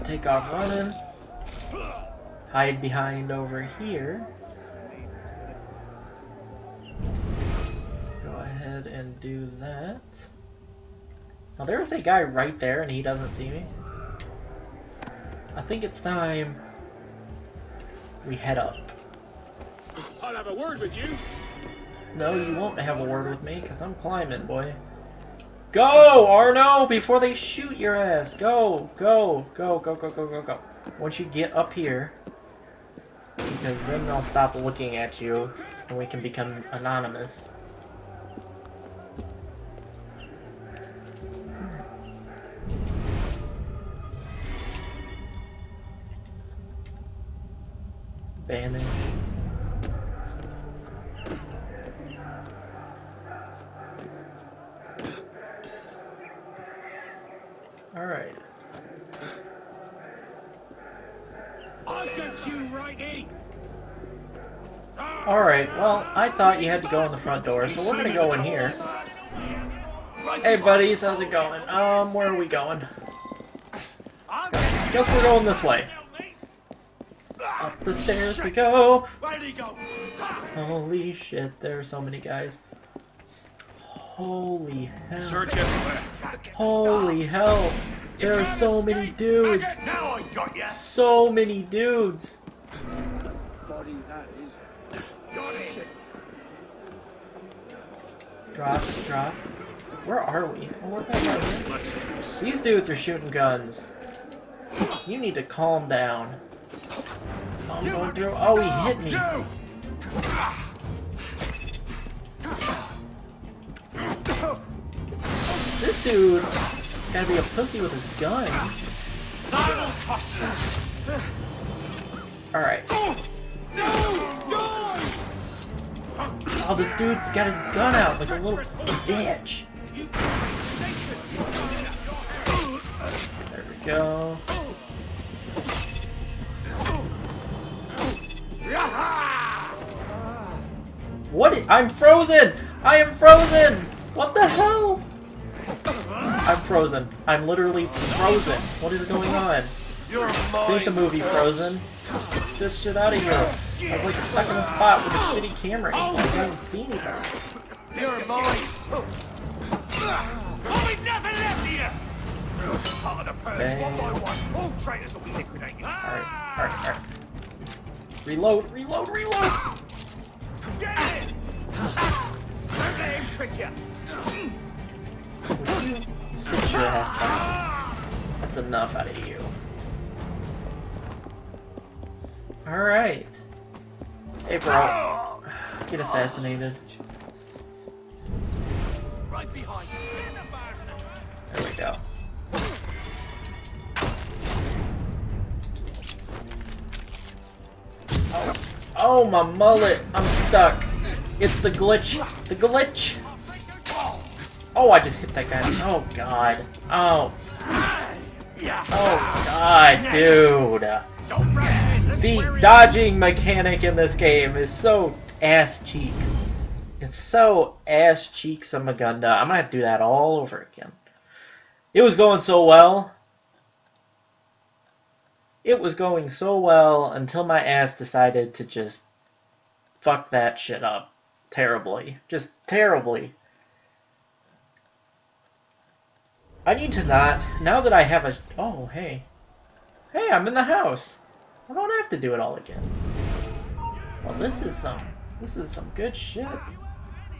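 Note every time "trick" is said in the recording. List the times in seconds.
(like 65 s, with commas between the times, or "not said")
173 s.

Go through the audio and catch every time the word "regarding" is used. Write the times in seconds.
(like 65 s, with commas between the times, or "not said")
not said.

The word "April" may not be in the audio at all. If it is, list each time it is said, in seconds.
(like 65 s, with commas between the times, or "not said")
184 s.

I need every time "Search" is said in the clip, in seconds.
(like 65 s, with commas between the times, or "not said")
85 s.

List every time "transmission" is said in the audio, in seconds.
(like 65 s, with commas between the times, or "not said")
not said.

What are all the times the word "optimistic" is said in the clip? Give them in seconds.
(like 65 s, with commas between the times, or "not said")
not said.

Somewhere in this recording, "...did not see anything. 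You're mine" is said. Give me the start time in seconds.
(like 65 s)
156 s.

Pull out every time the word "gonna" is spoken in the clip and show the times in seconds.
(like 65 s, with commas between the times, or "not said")
67 s, 219 s.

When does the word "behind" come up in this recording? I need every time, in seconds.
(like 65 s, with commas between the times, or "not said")
2 s, 189 s.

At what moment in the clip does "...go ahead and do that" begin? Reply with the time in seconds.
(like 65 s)
8 s.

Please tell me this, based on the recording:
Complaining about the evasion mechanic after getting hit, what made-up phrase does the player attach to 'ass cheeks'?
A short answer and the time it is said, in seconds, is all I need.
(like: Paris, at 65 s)
ass cheeks of Magunda, at 217 s.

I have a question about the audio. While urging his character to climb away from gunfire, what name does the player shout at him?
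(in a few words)
Arno.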